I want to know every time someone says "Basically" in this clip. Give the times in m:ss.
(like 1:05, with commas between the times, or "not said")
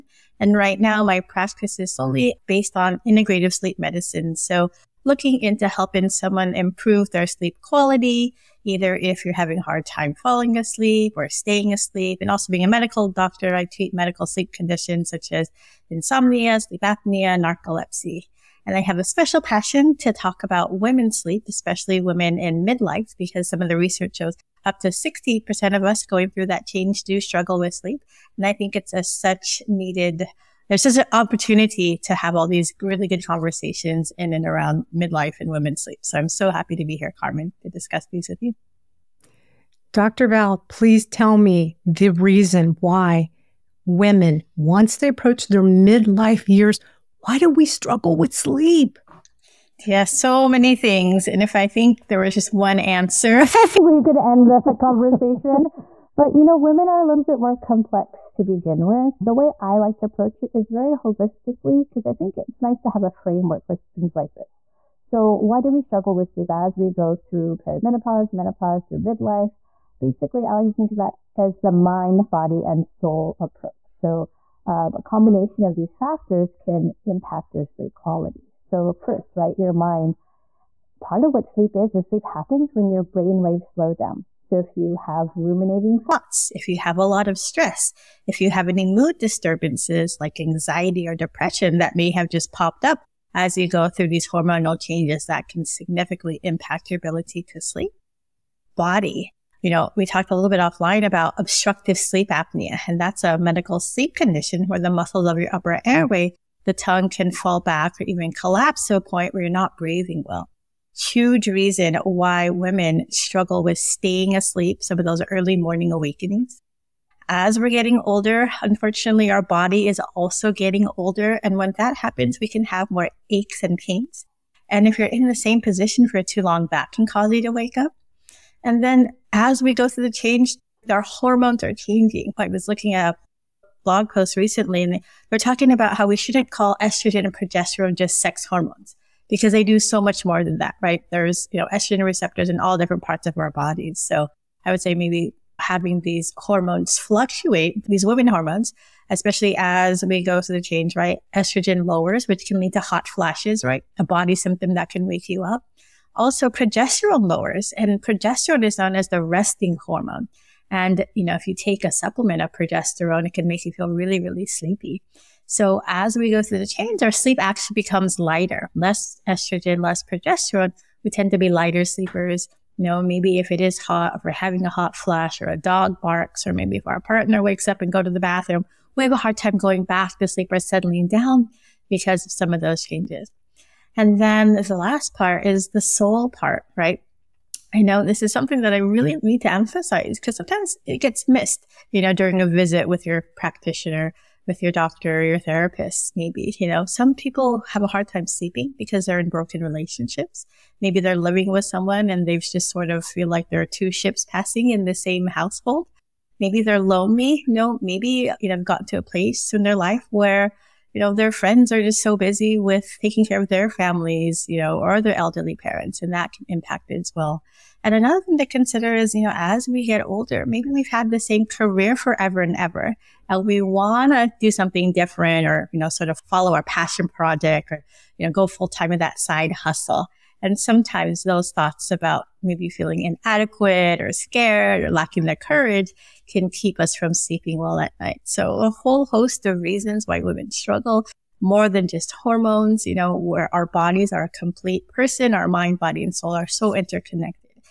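1:09.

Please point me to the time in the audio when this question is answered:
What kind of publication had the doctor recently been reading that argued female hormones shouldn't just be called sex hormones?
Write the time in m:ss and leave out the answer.
2:13.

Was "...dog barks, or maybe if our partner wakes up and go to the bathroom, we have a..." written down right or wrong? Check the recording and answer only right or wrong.
right.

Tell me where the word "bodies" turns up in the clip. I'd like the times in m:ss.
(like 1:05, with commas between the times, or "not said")
2:23, 4:03.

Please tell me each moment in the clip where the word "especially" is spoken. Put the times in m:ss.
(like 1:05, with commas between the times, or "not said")
0:21, 2:29.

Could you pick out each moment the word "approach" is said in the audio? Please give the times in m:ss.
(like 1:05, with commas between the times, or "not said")
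0:45, 1:00, 1:13.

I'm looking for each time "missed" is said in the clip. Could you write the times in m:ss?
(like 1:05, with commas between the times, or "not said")
3:11.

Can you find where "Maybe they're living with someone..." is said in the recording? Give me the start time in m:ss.
3:20.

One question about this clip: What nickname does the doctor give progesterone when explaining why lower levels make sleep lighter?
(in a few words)
the resting hormone.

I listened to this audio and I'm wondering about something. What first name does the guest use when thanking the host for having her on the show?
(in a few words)
Carmen.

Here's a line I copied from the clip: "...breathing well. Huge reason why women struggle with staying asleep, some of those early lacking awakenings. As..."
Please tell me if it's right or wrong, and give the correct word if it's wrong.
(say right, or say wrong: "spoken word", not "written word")
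wrong: "morning", not "lacking".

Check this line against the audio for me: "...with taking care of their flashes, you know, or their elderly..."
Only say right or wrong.
wrong.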